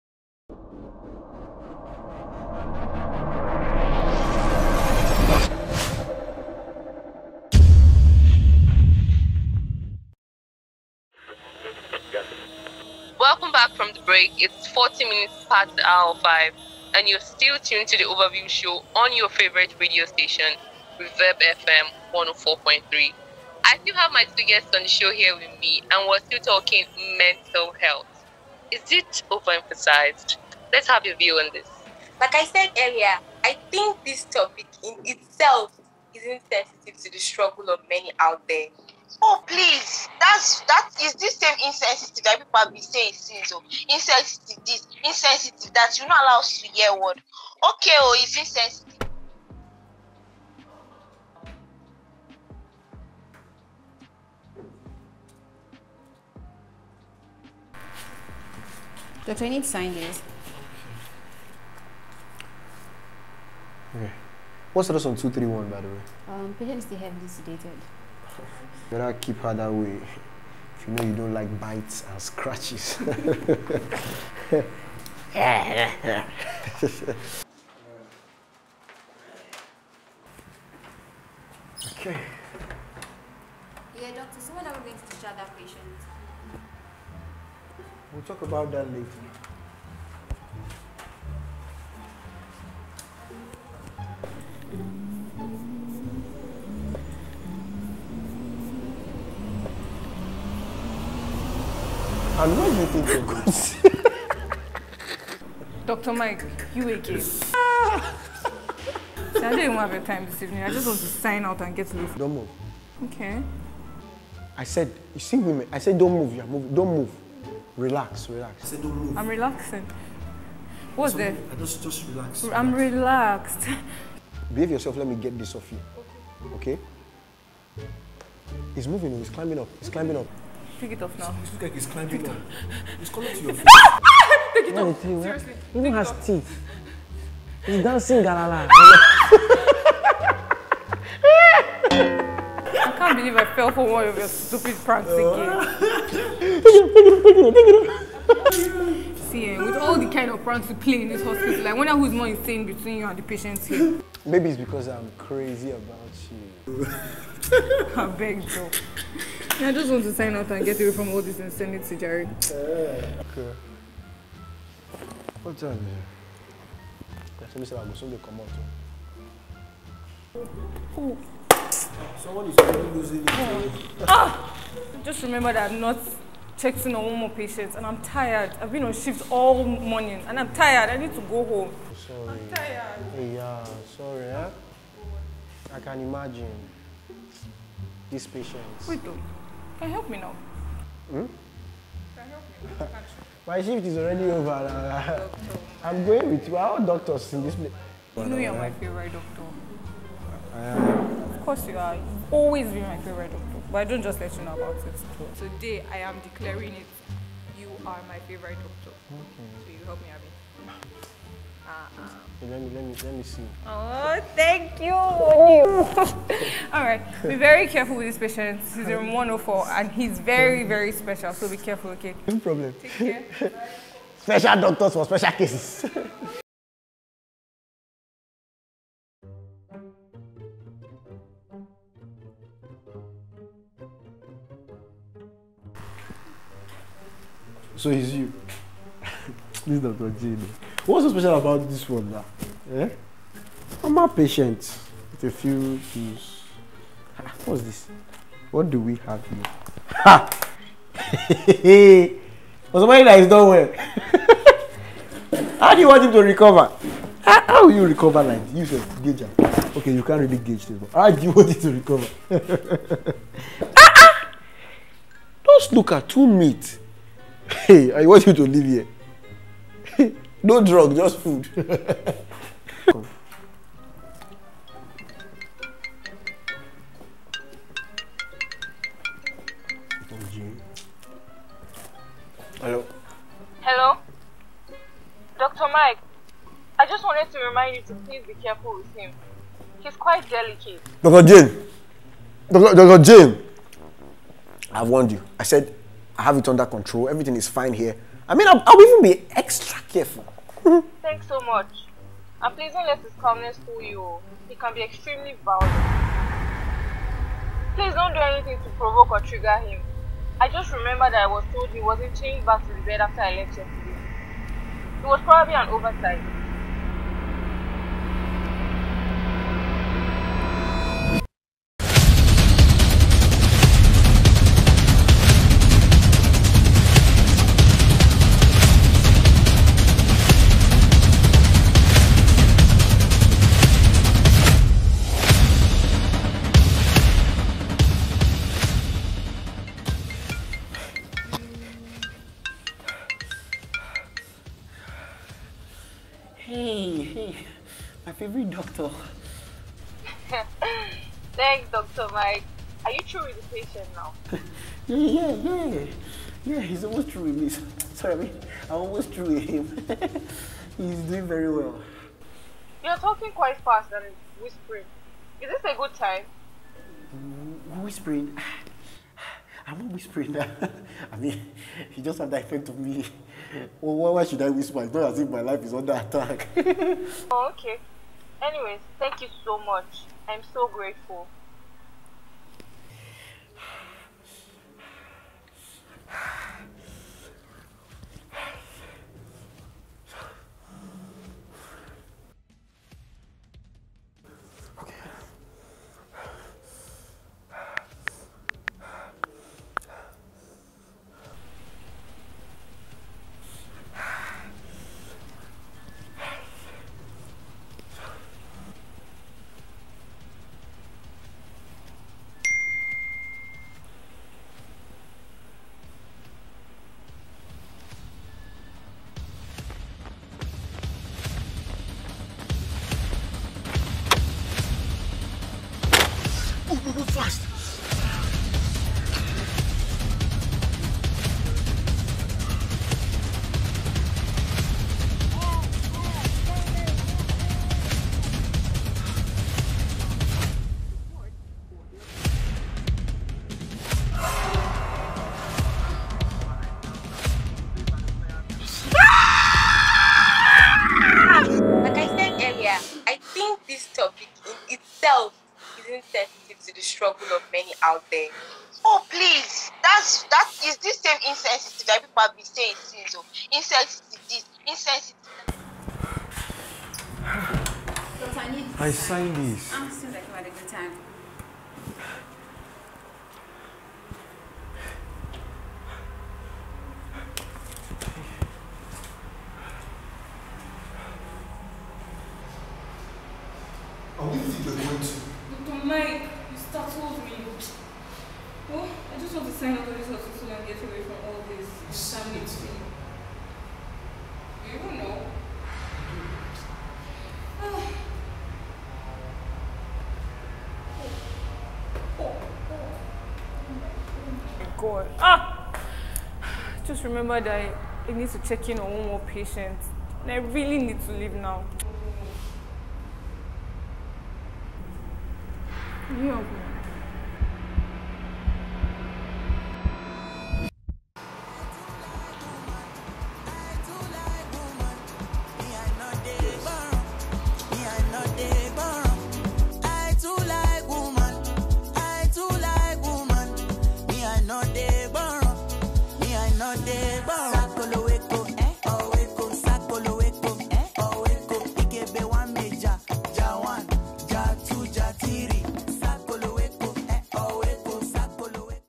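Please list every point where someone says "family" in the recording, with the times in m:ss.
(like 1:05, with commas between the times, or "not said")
8:12.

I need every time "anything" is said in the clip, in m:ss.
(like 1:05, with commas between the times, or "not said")
5:08.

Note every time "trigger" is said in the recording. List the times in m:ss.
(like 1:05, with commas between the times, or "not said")
5:09.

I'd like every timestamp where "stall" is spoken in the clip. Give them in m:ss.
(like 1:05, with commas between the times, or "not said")
not said.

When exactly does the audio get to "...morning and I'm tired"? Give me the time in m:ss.
2:59.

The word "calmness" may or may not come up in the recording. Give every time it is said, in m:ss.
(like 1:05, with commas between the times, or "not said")
5:03.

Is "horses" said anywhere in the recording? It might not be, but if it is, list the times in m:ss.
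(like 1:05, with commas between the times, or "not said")
not said.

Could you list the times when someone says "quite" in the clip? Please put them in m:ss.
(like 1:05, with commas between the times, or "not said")
4:49, 6:03.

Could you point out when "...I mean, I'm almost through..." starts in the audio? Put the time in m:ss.
5:58.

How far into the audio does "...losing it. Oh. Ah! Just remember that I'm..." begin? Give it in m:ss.
2:52.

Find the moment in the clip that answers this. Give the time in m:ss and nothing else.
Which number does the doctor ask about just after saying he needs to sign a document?
1:05.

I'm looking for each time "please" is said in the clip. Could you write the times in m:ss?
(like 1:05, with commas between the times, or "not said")
0:39, 4:48, 5:02, 5:07, 7:39.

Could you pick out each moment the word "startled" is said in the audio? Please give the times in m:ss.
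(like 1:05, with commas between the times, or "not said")
8:06.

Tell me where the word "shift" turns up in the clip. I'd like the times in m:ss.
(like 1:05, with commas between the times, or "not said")
2:58, 3:13.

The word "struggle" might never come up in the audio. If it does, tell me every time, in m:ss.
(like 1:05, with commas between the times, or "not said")
0:37.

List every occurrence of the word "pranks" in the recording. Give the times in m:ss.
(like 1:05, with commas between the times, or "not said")
2:24, 2:30.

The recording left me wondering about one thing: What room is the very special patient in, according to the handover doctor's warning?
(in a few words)
104.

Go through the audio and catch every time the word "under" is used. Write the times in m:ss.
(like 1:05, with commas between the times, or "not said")
4:56, 6:15.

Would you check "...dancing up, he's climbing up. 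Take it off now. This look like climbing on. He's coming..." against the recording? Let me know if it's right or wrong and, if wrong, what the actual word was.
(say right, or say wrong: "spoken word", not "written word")
wrong: "climbing", not "dancing".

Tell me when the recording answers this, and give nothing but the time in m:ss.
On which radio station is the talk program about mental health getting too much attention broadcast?
0:20.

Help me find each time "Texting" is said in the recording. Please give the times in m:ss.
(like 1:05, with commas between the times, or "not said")
2:56.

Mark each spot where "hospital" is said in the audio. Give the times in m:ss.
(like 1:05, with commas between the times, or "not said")
2:31, 8:10.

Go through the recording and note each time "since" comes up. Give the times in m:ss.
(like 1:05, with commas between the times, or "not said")
0:43, 7:42.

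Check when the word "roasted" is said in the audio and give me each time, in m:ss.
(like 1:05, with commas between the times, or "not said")
not said.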